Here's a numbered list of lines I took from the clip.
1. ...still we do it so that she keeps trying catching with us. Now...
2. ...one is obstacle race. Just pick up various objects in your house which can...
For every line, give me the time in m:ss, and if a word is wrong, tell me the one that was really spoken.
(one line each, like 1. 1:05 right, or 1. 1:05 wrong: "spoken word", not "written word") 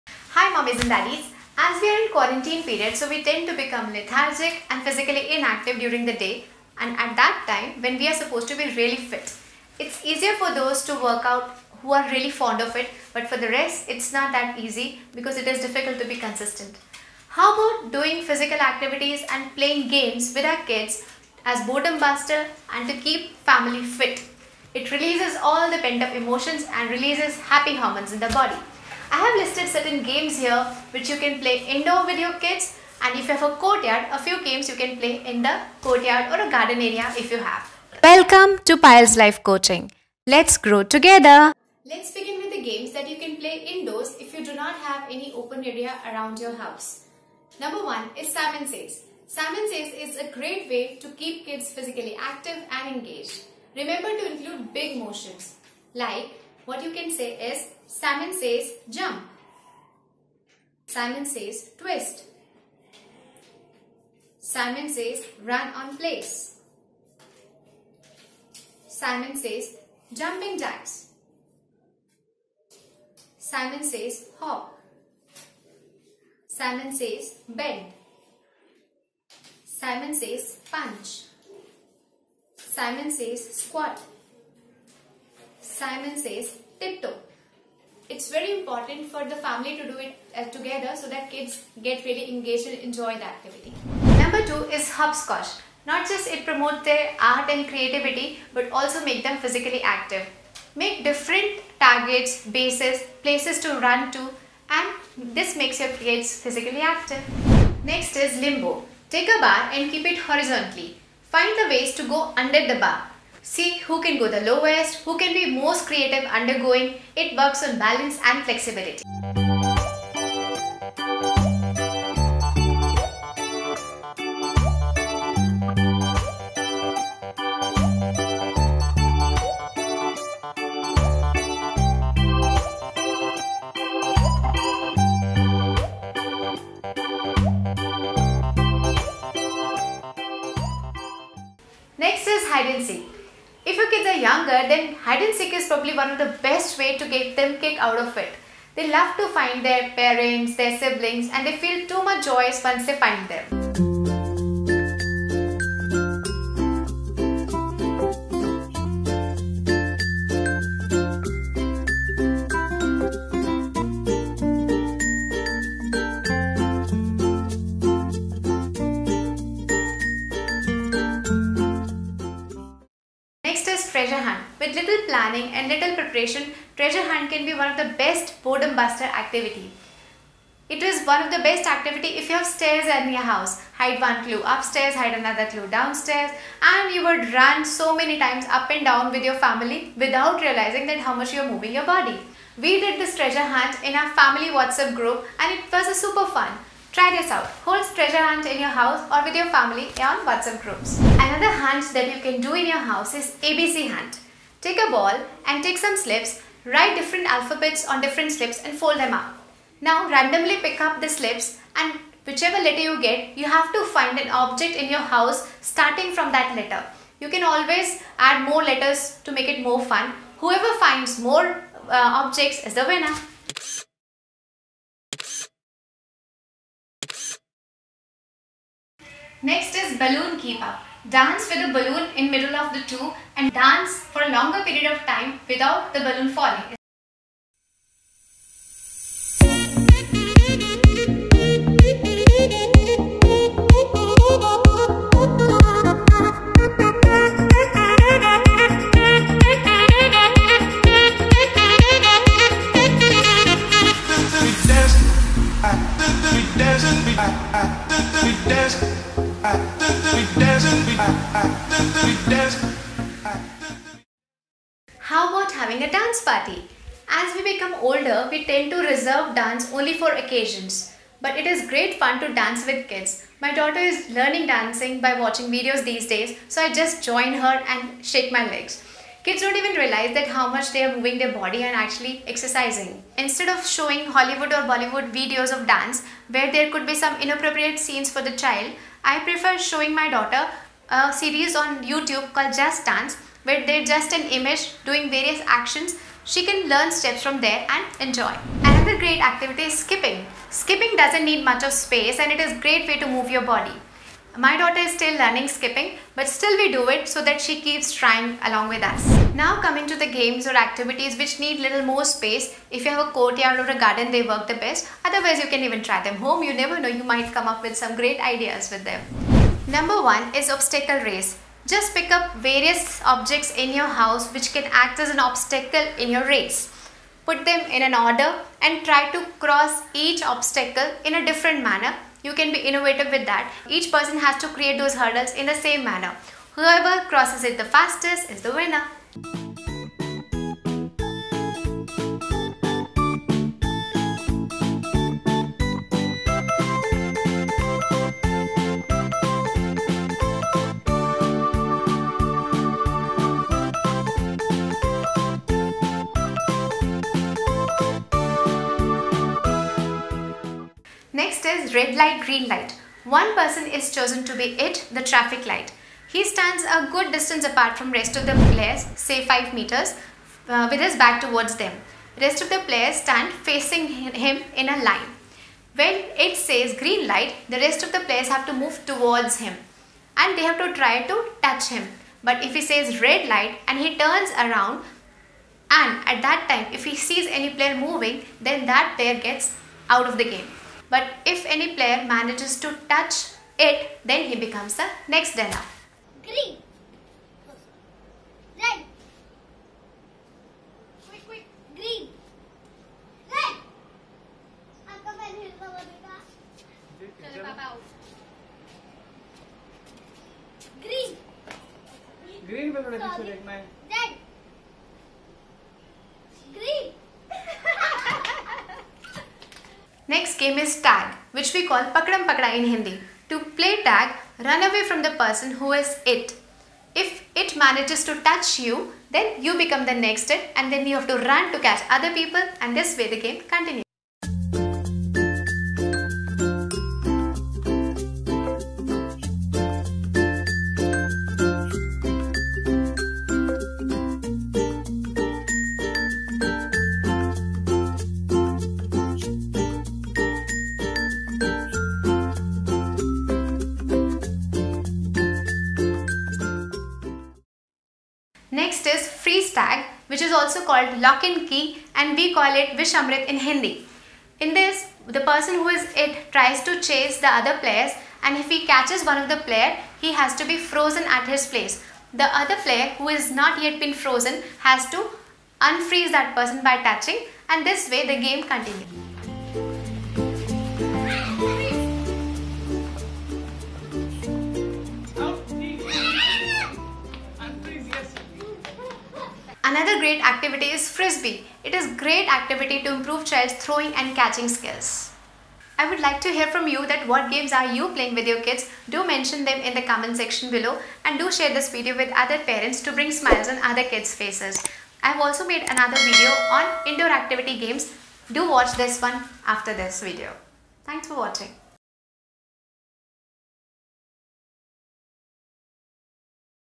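1. 5:06 wrong: "along", not "catching"
2. 5:20 right.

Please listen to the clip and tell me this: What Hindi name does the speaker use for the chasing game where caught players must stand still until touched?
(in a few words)
Vishamrit.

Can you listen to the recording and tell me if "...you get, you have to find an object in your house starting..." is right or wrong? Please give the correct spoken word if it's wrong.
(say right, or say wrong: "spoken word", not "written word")
right.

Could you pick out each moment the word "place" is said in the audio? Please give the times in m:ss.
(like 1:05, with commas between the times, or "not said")
1:05, 1:43, 7:51.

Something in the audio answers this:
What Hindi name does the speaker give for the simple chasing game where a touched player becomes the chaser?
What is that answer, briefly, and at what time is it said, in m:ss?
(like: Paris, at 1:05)
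pakram pakda, at 7:01.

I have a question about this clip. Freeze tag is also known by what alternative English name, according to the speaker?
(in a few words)
lock and key.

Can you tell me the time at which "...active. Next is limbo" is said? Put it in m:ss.
1:46.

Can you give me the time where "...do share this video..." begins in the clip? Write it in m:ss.
8:21.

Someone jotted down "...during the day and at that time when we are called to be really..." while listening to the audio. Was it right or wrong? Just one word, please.
wrong.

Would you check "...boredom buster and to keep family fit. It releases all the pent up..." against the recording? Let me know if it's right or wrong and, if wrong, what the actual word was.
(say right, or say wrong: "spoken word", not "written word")
right.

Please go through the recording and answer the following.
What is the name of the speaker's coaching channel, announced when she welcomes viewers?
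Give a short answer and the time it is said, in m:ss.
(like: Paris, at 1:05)
Payal's Life Coaching, at 0:38.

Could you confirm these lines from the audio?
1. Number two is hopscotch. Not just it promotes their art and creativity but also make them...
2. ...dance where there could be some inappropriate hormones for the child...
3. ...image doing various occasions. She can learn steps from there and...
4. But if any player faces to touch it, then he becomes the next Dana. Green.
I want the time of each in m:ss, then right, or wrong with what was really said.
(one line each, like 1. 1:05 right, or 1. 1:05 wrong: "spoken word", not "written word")
1. 1:34 right
2. 4:45 wrong: "scenes", not "hormones"
3. 4:54 wrong: "actions", not "occasions"
4. 6:30 wrong: "manages", not "faces".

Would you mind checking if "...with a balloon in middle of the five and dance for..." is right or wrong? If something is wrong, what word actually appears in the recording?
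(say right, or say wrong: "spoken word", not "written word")
wrong: "two", not "five".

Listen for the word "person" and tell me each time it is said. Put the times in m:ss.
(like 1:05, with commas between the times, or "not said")
5:33, 6:03, 7:05, 7:45, 7:56.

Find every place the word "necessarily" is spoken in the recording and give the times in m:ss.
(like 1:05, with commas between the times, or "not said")
not said.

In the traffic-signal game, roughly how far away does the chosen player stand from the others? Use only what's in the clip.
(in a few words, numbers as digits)
5 meters.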